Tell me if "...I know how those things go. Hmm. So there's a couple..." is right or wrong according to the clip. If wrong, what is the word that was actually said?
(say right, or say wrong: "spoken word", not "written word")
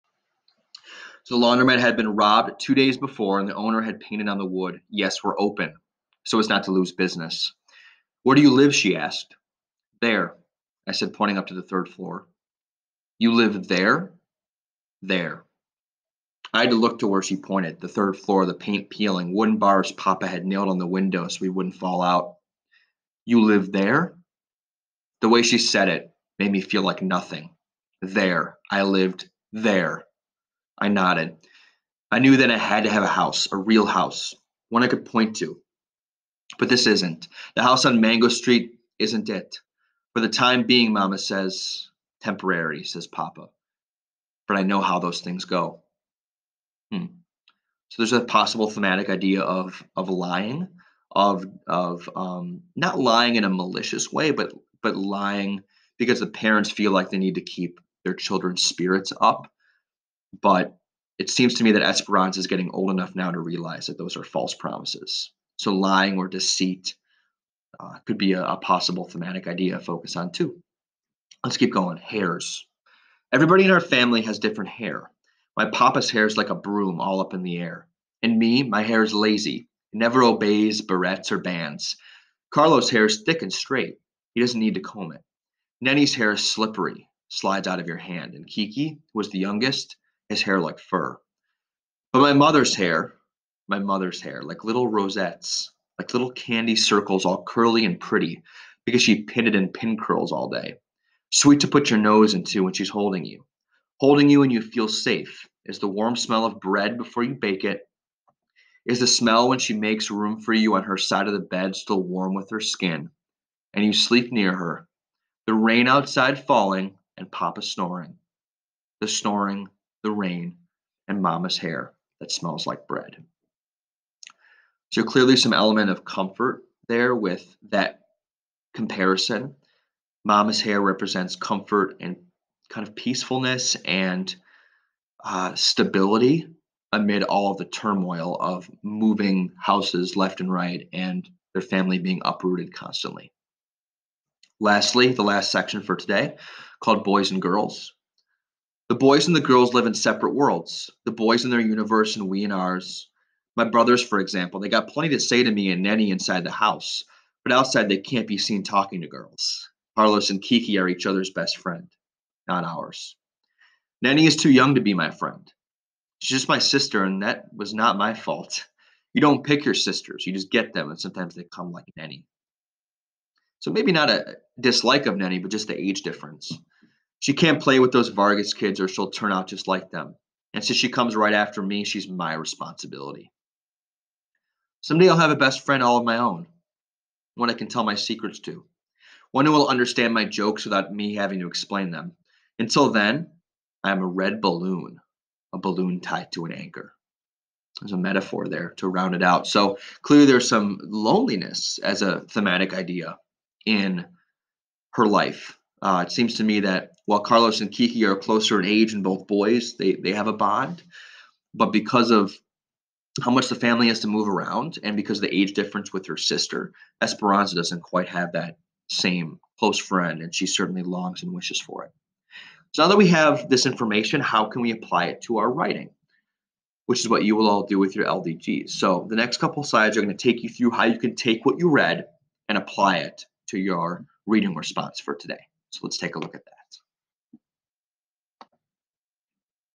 wrong: "possible", not "couple".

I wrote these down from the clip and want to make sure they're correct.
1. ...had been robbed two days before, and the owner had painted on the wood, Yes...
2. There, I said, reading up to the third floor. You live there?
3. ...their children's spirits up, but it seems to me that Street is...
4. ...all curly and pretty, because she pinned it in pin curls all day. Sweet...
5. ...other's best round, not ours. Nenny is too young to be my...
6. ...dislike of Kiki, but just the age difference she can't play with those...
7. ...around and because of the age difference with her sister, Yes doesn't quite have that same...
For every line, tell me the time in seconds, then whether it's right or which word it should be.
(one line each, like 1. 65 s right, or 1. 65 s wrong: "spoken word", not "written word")
1. 1 s right
2. 10 s wrong: "pointing", not "reading"
3. 58 s wrong: "Esperanza", not "Street"
4. 97 s right
5. 161 s wrong: "friend", not "round"
6. 174 s wrong: "Nenny", not "Kiki"
7. 214 s wrong: "Esperanza", not "Yes".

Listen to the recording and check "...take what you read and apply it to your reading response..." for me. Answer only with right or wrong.
right.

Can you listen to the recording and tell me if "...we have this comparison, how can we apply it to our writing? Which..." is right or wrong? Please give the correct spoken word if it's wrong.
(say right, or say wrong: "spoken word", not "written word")
wrong: "information", not "comparison".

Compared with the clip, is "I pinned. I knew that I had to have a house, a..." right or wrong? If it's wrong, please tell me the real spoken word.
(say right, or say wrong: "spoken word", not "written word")
wrong: "nodded", not "pinned".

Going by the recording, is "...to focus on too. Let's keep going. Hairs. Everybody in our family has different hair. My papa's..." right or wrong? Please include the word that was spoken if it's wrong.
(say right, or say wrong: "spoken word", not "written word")
right.